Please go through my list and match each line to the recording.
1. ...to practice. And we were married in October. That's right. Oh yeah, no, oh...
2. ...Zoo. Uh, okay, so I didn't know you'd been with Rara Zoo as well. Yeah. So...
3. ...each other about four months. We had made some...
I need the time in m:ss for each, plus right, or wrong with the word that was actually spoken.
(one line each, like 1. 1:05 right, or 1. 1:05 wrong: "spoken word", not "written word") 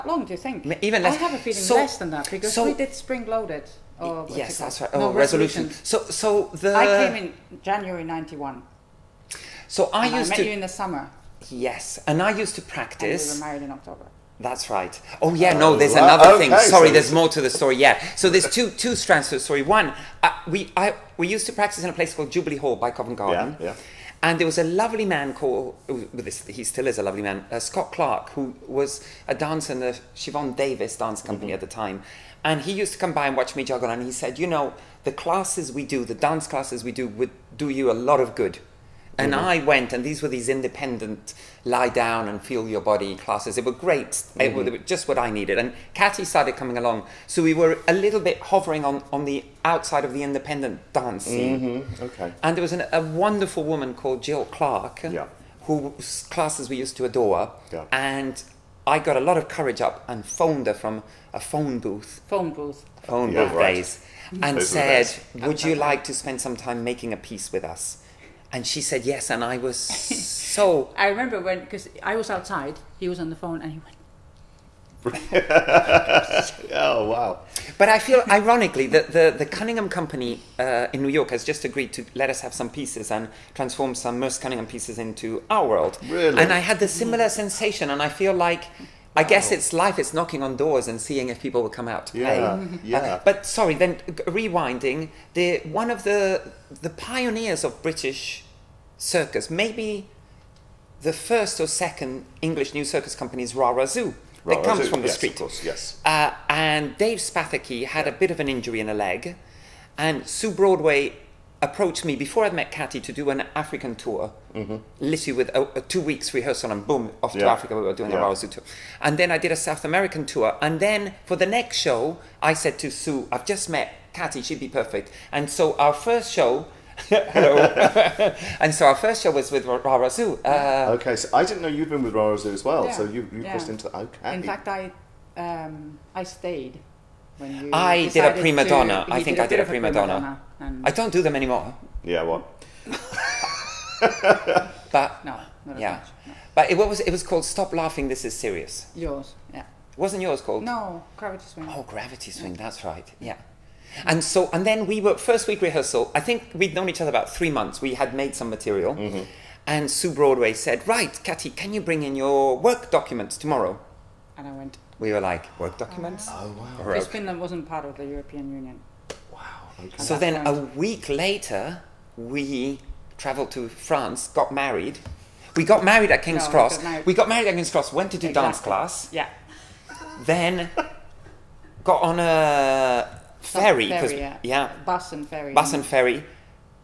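1. 0:12 right
2. 2:10 right
3. 2:36 wrong: "three", not "four".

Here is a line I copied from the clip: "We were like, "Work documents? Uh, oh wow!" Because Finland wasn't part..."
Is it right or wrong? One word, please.
right.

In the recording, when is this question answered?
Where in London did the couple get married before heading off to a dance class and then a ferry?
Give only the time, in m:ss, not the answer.
2:57.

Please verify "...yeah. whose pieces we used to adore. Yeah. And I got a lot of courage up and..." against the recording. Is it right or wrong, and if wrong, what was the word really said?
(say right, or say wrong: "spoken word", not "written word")
wrong: "classes", not "pieces".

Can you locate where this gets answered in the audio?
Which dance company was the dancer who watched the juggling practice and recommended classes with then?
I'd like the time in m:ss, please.
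0:30.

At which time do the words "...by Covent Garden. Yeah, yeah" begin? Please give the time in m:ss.
0:22.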